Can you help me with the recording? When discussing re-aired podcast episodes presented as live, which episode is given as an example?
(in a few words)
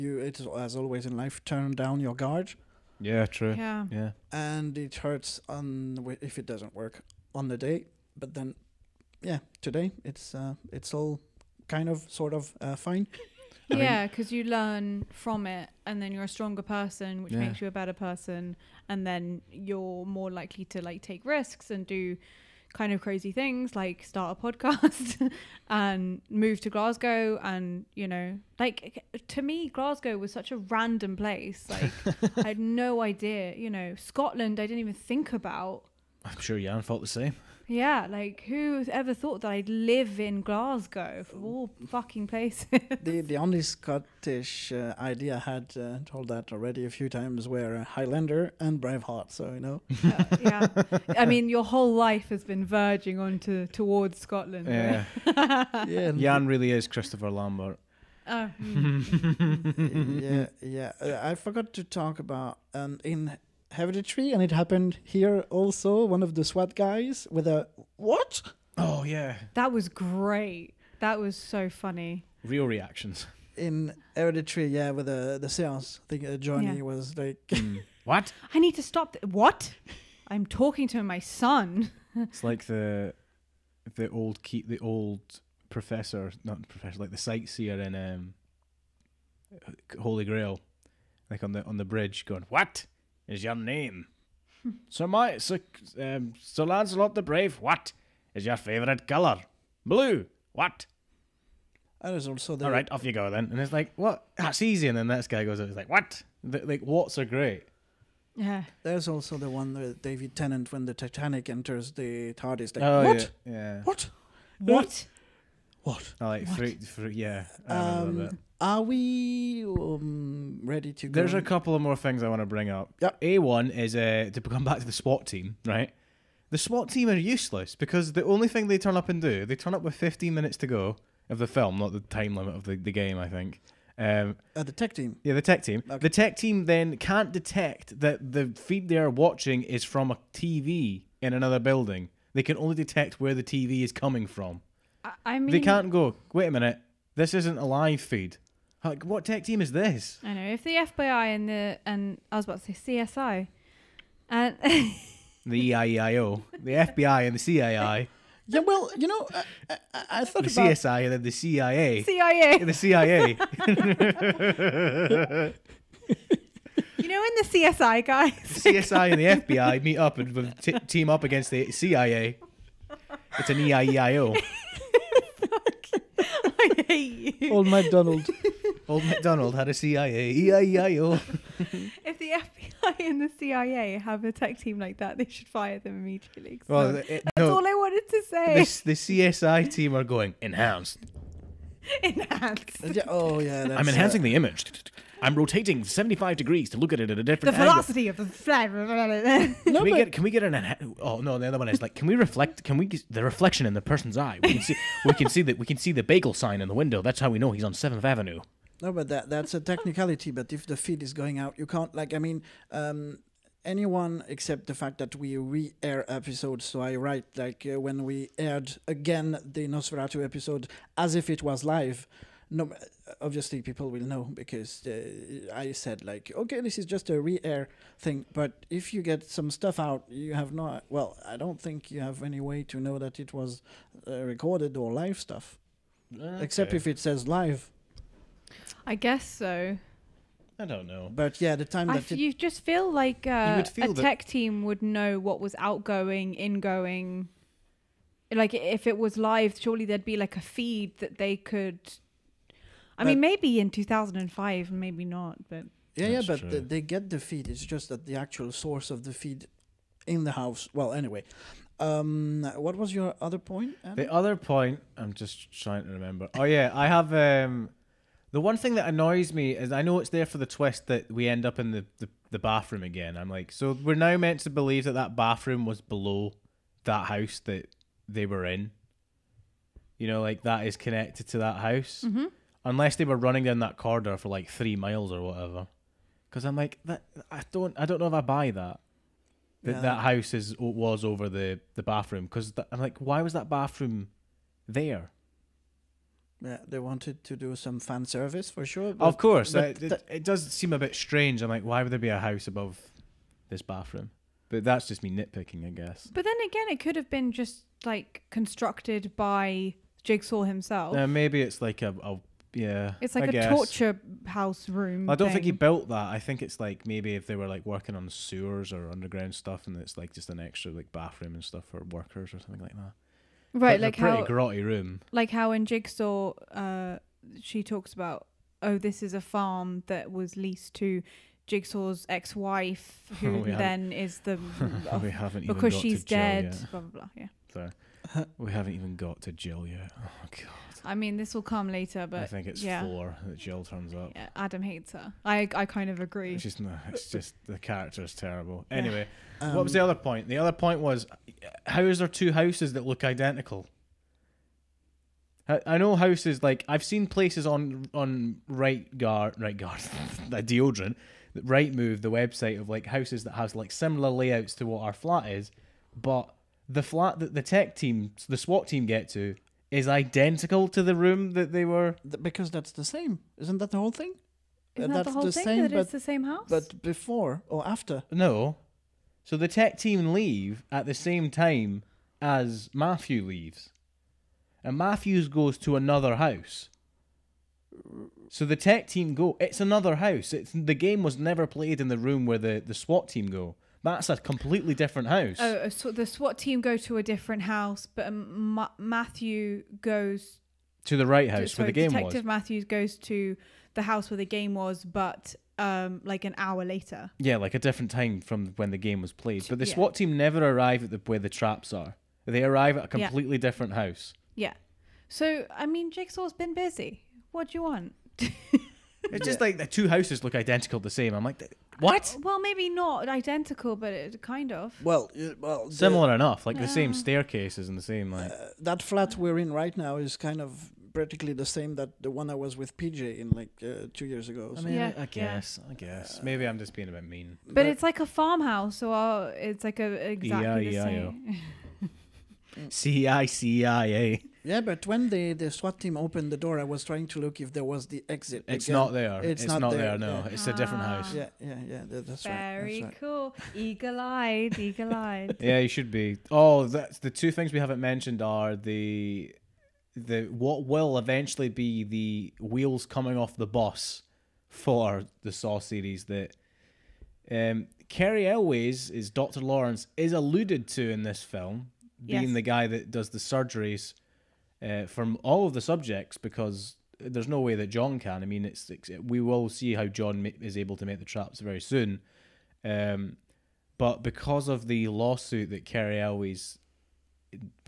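Nosferatu.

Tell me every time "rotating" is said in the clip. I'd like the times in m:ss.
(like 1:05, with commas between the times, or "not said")
3:15.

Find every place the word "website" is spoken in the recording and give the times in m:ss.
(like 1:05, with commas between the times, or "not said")
6:02.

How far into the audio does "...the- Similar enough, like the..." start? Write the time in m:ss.
7:05.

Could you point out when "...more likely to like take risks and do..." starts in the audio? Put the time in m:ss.
0:20.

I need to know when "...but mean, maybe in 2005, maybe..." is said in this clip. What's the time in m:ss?
4:13.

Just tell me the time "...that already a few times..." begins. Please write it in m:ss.
0:46.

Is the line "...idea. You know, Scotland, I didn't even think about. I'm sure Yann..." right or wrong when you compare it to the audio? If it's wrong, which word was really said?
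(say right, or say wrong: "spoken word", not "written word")
right.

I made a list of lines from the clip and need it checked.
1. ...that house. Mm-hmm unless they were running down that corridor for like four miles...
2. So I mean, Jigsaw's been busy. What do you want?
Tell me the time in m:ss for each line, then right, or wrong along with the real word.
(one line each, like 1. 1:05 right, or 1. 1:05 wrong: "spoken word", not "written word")
1. 4:41 wrong: "three", not "four"
2. 6:55 right.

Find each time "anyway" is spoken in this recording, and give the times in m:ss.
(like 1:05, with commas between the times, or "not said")
4:20, 5:48.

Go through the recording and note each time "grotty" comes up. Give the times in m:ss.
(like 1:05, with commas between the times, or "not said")
5:24.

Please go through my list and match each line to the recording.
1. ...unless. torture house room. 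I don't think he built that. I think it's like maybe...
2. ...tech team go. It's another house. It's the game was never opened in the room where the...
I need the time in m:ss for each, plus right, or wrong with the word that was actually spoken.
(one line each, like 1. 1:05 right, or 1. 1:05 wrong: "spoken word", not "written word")
1. 5:13 wrong: "guess", not "unless"
2. 6:28 wrong: "played", not "opened".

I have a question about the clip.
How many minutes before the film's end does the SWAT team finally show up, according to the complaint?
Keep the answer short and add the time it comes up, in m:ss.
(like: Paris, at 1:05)
15, at 2:09.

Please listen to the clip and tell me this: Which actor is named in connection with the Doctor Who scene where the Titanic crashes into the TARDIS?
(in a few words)
David Tennant.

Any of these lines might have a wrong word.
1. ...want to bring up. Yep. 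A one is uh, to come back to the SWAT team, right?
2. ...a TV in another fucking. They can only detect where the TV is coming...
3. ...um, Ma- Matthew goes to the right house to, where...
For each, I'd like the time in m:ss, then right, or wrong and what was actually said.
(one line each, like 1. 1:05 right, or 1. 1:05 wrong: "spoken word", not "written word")
1. 2:02 right
2. 2:20 wrong: "building", not "fucking"
3. 6:38 right.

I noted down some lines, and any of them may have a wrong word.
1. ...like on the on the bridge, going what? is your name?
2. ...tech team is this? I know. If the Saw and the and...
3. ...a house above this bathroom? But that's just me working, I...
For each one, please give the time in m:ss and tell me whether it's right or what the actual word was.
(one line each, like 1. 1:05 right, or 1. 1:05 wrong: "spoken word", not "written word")
1. 1:31 right
2. 2:29 wrong: "FBI", not "Saw"
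3. 5:02 wrong: "nitpicking", not "working".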